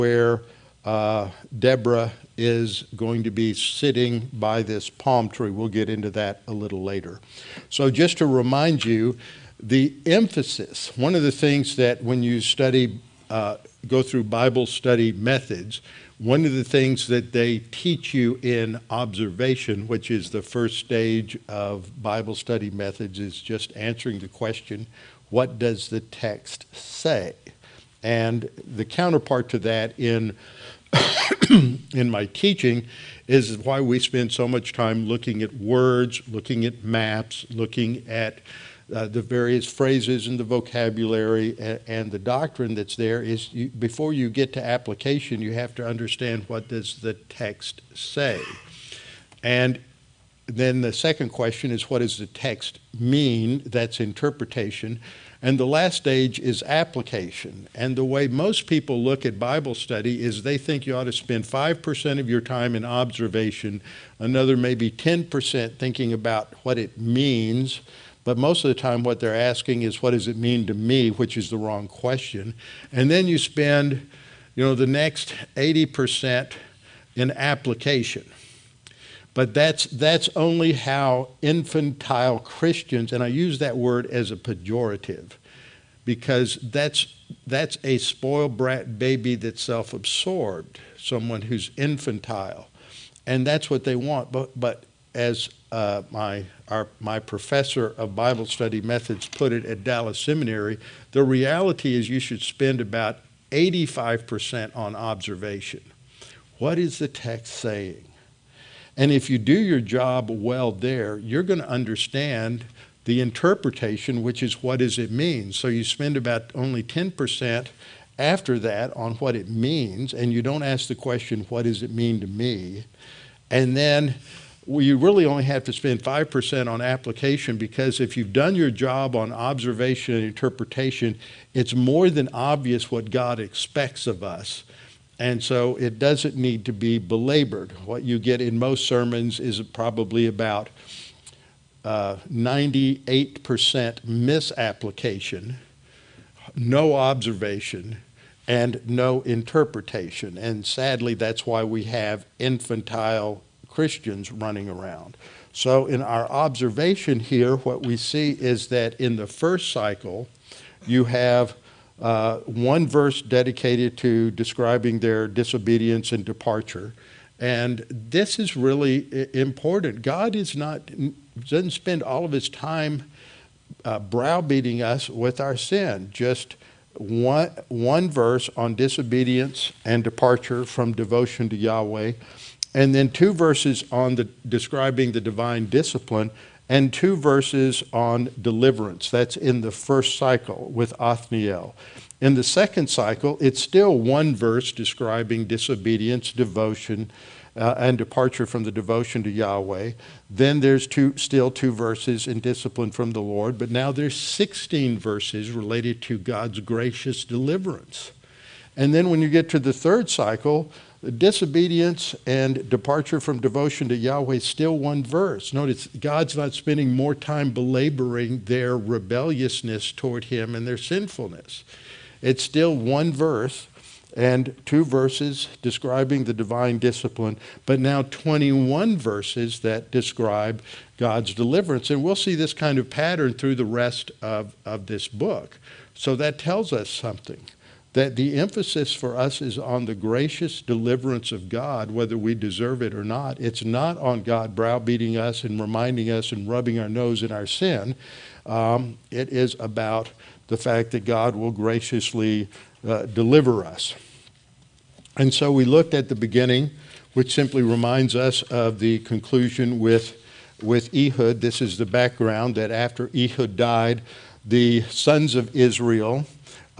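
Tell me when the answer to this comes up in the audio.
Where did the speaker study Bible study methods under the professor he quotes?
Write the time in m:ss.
1:39.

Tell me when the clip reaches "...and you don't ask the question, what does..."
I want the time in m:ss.
2:00.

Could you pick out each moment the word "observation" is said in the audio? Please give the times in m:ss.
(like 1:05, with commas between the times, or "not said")
0:18, 1:02, 1:44, 2:09, 2:26, 2:36.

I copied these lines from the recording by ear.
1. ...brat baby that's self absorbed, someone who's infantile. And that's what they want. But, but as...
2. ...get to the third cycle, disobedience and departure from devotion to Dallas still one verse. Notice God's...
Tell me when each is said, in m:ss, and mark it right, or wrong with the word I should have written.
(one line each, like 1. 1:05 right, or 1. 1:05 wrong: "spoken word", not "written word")
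1. 1:28 right
2. 3:29 wrong: "Yahweh", not "Dallas".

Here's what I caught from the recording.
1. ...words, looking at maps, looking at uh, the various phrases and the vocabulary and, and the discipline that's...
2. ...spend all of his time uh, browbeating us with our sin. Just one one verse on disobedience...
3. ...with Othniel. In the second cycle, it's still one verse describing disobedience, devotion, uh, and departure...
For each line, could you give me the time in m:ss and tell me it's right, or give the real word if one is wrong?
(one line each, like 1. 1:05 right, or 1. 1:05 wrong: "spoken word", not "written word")
1. 0:35 wrong: "doctrine", not "discipline"
2. 2:51 right
3. 3:10 right.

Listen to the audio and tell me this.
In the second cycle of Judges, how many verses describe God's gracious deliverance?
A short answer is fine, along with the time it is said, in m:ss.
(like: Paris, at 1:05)
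16, at 3:24.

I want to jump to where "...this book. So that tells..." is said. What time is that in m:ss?
3:54.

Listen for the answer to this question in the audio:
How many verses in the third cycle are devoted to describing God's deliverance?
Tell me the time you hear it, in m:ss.
3:48.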